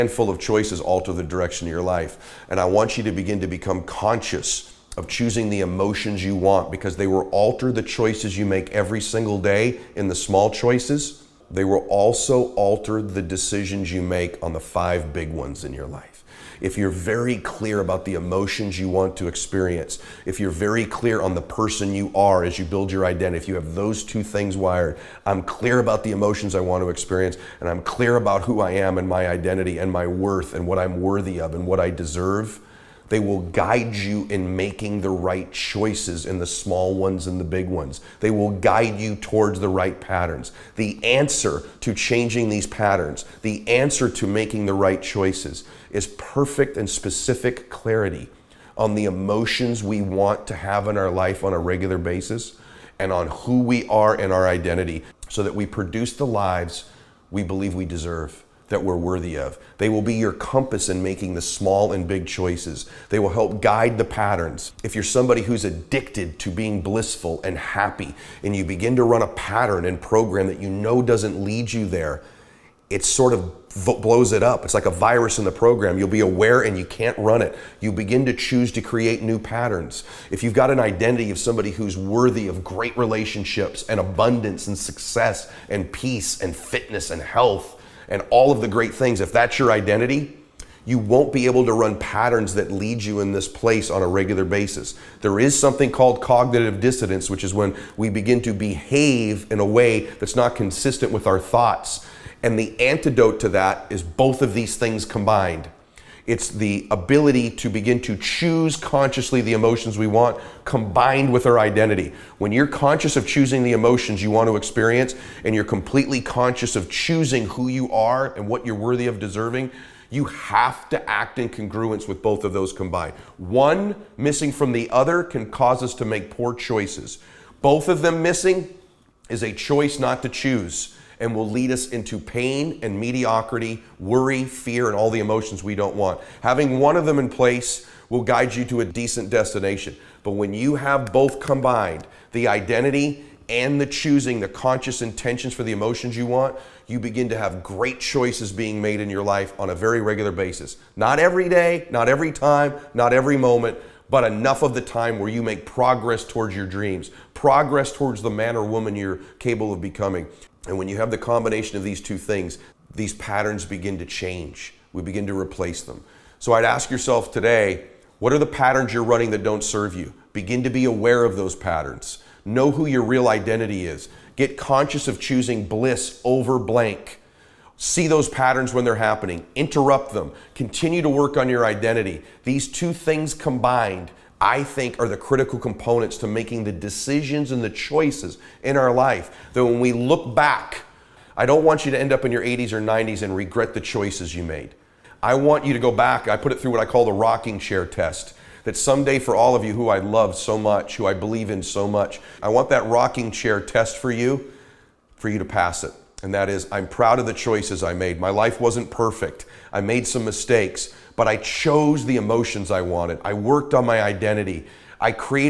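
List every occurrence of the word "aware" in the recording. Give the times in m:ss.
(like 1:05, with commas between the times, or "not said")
1:16, 2:50.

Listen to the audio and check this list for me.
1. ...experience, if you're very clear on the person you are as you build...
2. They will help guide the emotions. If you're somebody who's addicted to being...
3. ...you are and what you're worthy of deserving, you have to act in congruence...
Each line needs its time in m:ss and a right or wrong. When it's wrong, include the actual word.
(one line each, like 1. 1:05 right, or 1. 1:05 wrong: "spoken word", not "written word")
1. 0:19 right
2. 1:03 wrong: "patterns", not "emotions"
3. 1:57 right.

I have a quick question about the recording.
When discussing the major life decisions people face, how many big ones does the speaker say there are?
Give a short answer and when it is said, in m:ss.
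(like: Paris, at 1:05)
5, at 0:14.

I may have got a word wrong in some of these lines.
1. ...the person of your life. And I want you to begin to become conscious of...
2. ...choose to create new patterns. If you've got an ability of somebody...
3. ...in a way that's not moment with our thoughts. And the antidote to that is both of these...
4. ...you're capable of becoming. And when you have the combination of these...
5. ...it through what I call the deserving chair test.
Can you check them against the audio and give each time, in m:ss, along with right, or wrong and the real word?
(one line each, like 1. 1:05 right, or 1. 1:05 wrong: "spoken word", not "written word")
1. 0:01 wrong: "direction", not "person"
2. 1:18 wrong: "identity", not "ability"
3. 1:39 wrong: "consistent", not "moment"
4. 2:38 right
5. 3:16 wrong: "rocking", not "deserving".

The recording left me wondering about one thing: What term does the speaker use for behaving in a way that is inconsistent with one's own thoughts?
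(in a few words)
Cognitive dissonance.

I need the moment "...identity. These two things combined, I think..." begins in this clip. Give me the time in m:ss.
3:01.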